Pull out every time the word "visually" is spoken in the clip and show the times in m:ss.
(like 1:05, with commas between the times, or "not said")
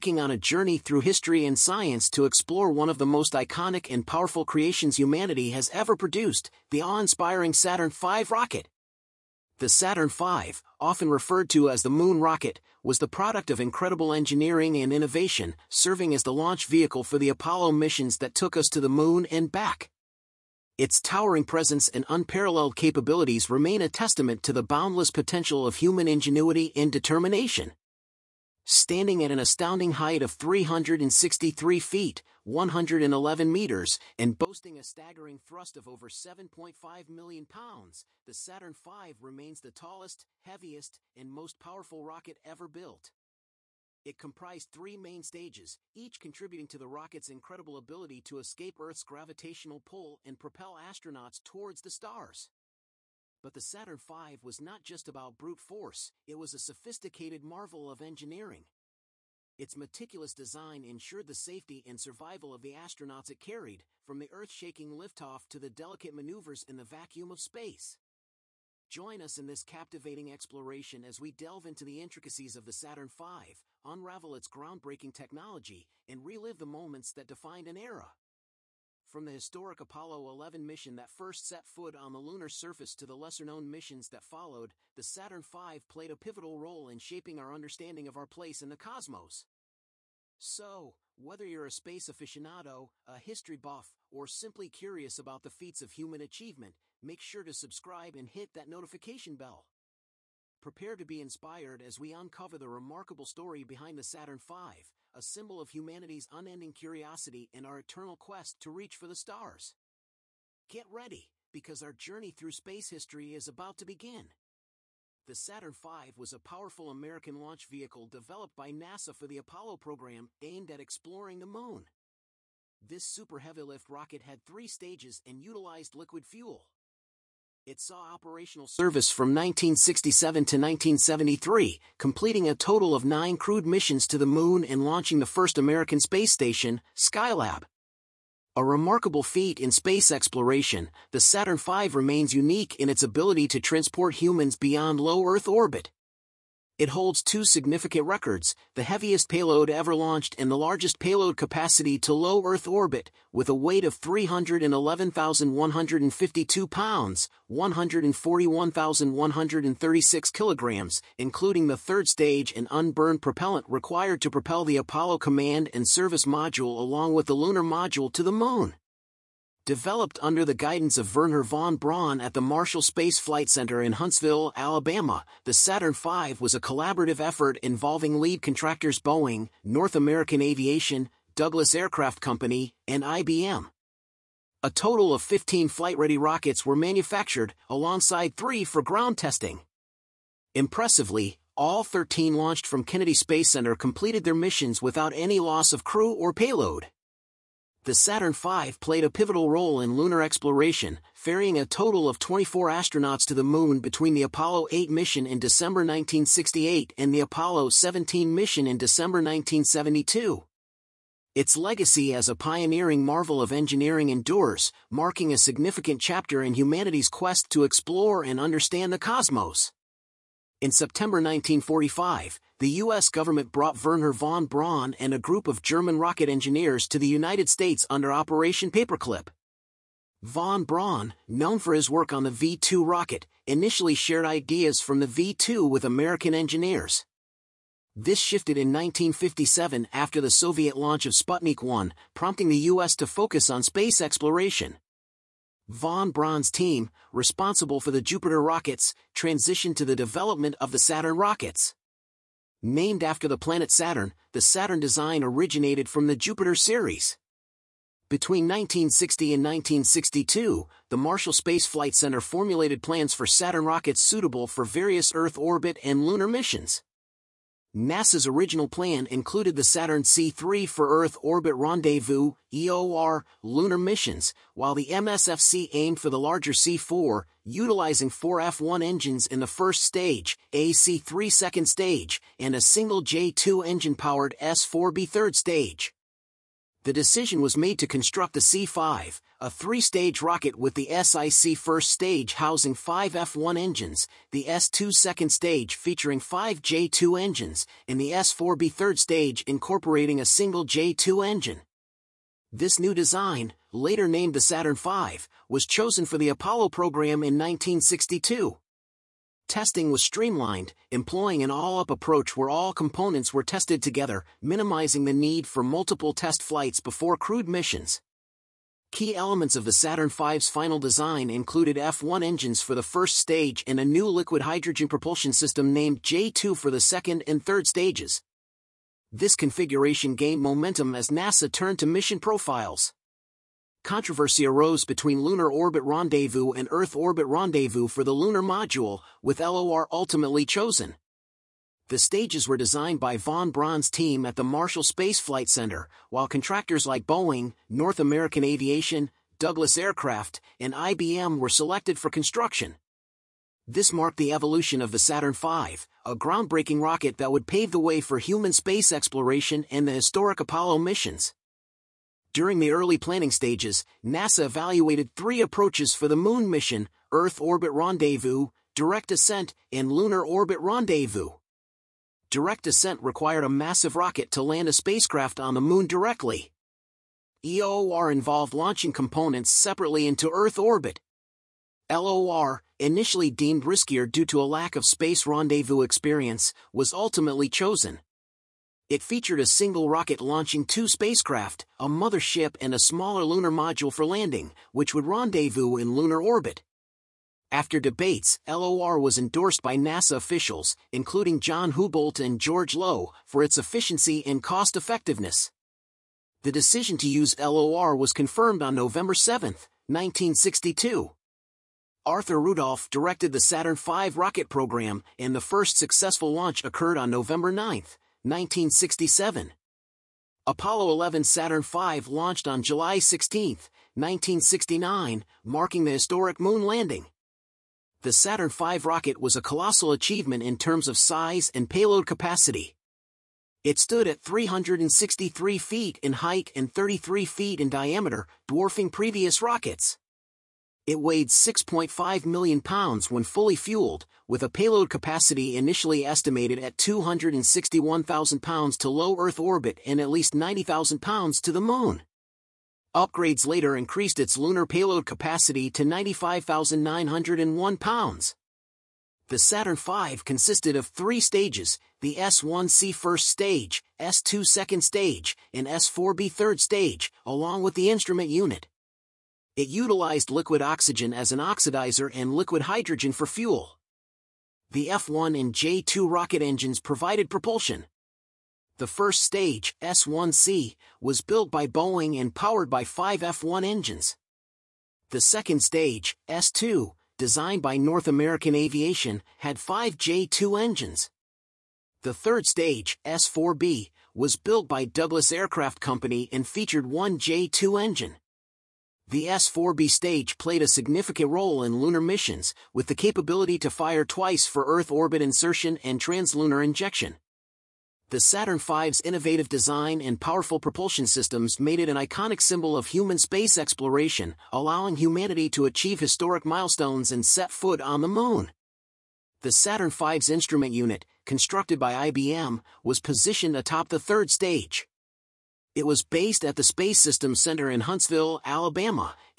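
not said.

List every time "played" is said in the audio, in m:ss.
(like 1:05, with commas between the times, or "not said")
1:25, 3:18, 8:20.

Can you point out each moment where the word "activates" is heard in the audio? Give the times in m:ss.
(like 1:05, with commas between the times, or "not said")
not said.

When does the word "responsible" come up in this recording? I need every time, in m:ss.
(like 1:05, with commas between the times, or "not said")
4:07.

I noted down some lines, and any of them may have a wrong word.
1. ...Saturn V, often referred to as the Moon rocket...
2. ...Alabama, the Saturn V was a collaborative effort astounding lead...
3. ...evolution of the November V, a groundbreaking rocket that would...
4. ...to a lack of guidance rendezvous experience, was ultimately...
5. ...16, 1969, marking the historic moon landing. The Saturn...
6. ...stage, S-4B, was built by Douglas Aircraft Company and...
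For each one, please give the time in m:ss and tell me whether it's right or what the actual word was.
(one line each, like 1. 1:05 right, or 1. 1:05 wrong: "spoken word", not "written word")
1. 0:09 right
2. 2:54 wrong: "involving", not "astounding"
3. 5:54 wrong: "Saturn", not "November"
4. 6:24 wrong: "space", not "guidance"
5. 7:02 right
6. 8:12 right.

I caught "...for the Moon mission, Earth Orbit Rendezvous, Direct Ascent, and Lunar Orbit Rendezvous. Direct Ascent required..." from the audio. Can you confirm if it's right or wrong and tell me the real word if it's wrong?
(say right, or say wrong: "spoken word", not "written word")
right.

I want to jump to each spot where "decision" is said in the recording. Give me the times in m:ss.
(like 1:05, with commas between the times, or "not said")
4:46, 6:46.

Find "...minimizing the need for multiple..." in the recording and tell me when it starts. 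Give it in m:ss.
5:14.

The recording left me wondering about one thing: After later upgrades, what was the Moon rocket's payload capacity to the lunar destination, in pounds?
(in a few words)
95,901 pounds.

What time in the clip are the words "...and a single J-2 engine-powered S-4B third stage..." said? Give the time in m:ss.
4:42.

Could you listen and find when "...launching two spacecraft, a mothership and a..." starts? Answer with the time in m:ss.
6:30.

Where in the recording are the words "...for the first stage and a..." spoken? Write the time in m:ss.
5:22.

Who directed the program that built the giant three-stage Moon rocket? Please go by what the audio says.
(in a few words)
Arthur Rudolph.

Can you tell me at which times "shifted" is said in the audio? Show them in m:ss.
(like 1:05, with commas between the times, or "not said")
3:58.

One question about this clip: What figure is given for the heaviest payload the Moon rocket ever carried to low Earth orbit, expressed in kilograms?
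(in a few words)
141,136 kilograms.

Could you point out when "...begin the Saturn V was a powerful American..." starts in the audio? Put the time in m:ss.
1:53.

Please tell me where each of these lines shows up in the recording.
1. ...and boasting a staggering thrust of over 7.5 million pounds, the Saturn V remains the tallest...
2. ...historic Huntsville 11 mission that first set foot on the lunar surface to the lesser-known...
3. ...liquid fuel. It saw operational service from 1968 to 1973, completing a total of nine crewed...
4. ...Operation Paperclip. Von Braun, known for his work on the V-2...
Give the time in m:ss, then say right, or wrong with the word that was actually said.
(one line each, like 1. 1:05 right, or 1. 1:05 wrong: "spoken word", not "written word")
1. 0:34 right
2. 1:19 wrong: "Apollo", not "Huntsville"
3. 2:05 wrong: "1967", not "1968"
4. 3:48 right.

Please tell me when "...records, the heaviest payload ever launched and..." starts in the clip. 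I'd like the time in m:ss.
2:28.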